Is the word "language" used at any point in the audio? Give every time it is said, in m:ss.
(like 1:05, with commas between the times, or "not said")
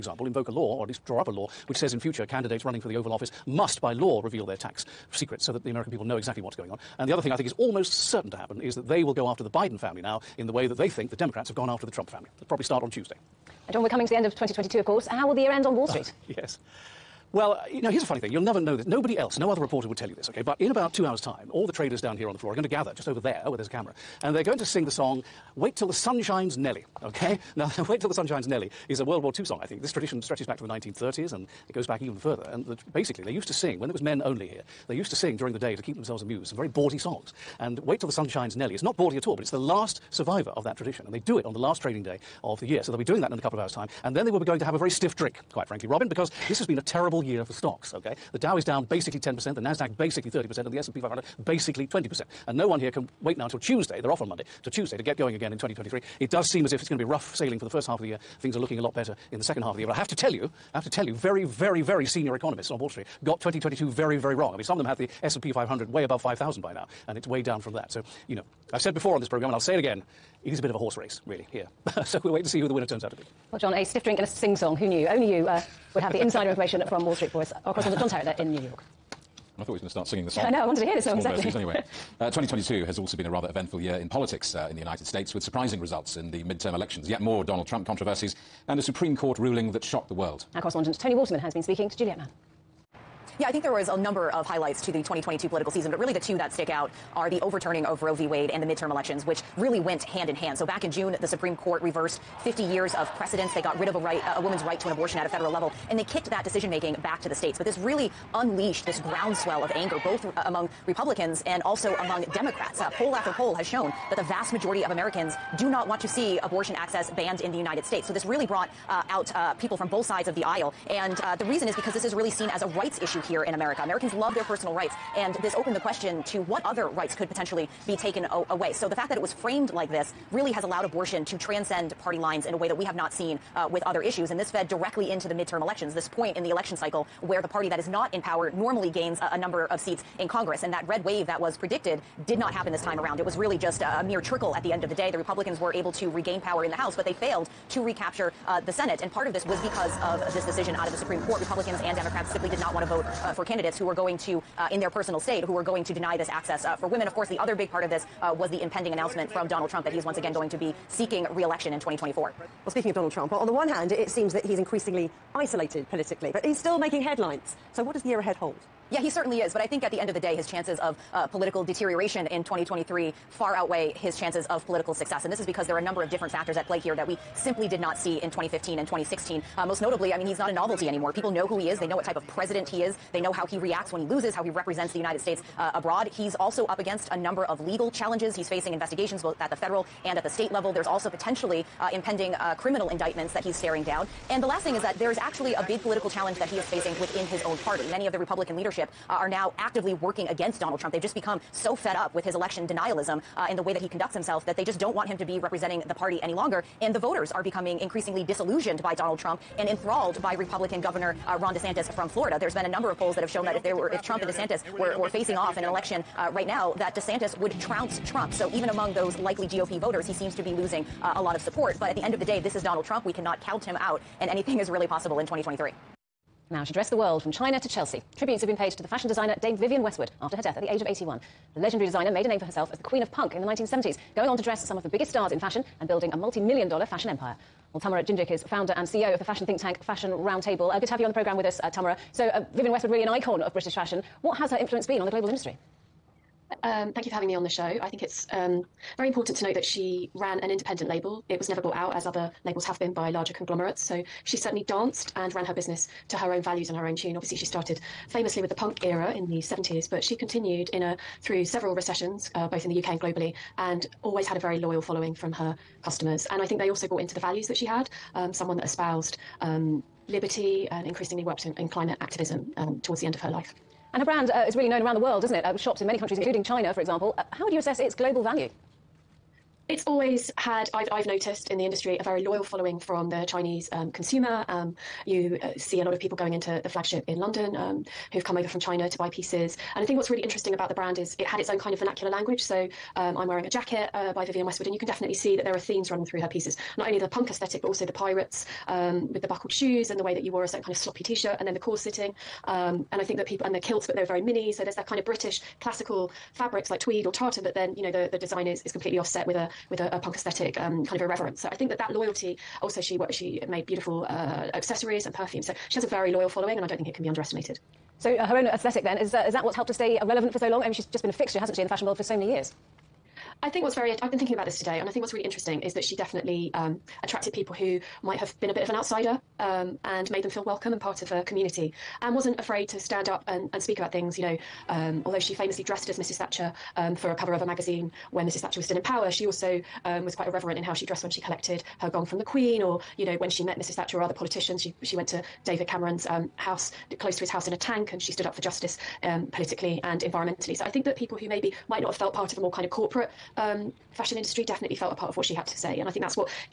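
4:52.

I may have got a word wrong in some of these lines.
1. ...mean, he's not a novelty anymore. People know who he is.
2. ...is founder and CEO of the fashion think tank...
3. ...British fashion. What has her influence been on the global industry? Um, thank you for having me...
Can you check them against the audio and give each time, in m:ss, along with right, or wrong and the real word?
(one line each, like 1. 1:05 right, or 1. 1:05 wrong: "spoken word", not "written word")
1. 3:00 right
2. 3:58 right
3. 4:03 right.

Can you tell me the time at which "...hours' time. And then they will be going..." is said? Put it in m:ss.
0:43.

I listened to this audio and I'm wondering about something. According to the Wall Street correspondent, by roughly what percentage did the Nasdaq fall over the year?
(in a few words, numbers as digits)
30%.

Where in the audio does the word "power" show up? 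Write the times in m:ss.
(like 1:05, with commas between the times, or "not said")
2:18, 2:26, 5:38.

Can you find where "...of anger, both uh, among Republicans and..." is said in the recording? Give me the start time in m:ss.
1:49.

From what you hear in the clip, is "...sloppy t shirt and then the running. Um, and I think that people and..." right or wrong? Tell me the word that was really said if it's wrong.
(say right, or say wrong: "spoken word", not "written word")
wrong: "corseting", not "running".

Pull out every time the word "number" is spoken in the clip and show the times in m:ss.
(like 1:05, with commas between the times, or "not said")
1:33, 2:19, 2:55, 3:07, 3:32.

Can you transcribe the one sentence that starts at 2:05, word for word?
And this opened the question to what other rights could potentially be taken away.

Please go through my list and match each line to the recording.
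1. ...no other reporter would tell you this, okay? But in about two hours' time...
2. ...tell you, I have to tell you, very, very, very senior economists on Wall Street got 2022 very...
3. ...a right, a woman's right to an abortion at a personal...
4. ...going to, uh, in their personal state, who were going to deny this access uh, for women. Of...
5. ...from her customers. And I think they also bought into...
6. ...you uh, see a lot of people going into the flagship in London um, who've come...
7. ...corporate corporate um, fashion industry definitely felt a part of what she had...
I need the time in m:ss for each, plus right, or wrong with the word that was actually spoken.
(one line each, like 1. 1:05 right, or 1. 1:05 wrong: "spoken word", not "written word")
1. 0:19 right
2. 1:00 right
3. 1:43 wrong: "federal", not "personal"
4. 2:33 right
5. 4:25 right
6. 4:45 right
7. 5:52 right.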